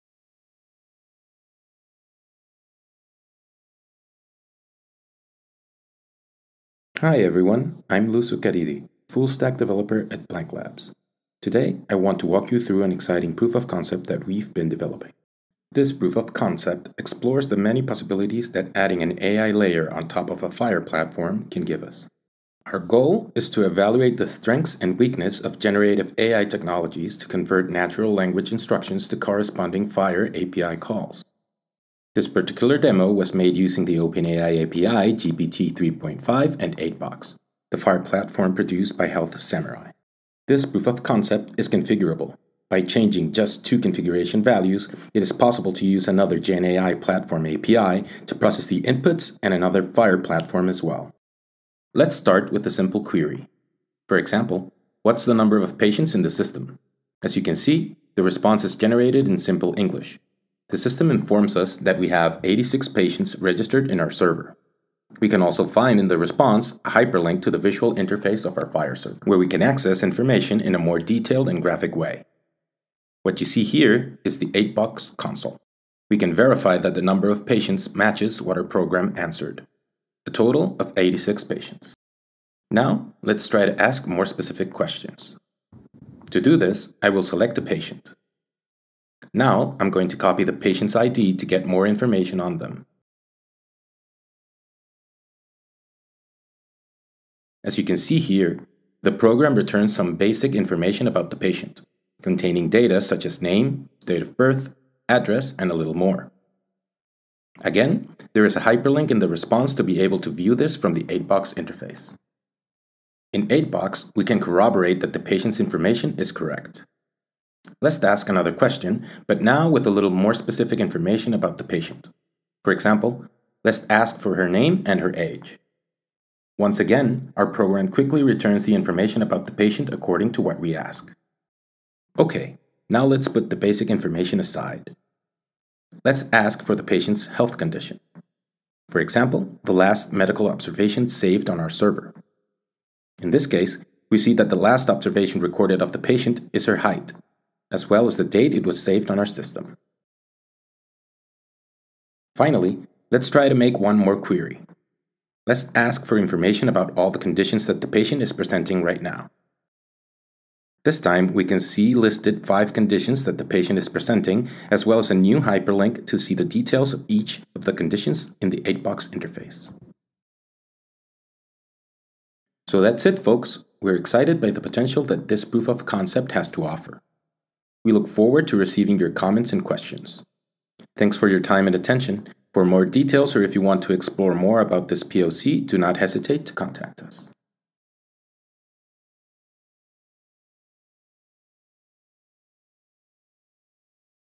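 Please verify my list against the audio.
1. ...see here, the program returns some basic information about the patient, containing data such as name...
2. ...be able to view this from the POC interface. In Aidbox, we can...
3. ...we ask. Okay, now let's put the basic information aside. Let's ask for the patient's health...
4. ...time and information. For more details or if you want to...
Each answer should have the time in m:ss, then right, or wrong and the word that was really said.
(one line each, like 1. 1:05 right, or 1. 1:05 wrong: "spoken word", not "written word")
1. 1:37 right
2. 1:49 wrong: "Aidbox", not "POC"
3. 2:10 right
4. 3:01 wrong: "attention", not "information".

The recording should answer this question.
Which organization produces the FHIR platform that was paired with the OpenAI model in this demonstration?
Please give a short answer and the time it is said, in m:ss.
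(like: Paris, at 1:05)
Health Samurai, at 0:39.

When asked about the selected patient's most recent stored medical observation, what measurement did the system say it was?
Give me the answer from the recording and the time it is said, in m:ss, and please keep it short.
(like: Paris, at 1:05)
height, at 2:26.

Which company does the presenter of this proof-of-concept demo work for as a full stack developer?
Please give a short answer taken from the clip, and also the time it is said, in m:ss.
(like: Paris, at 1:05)
Blanc Labs, at 0:10.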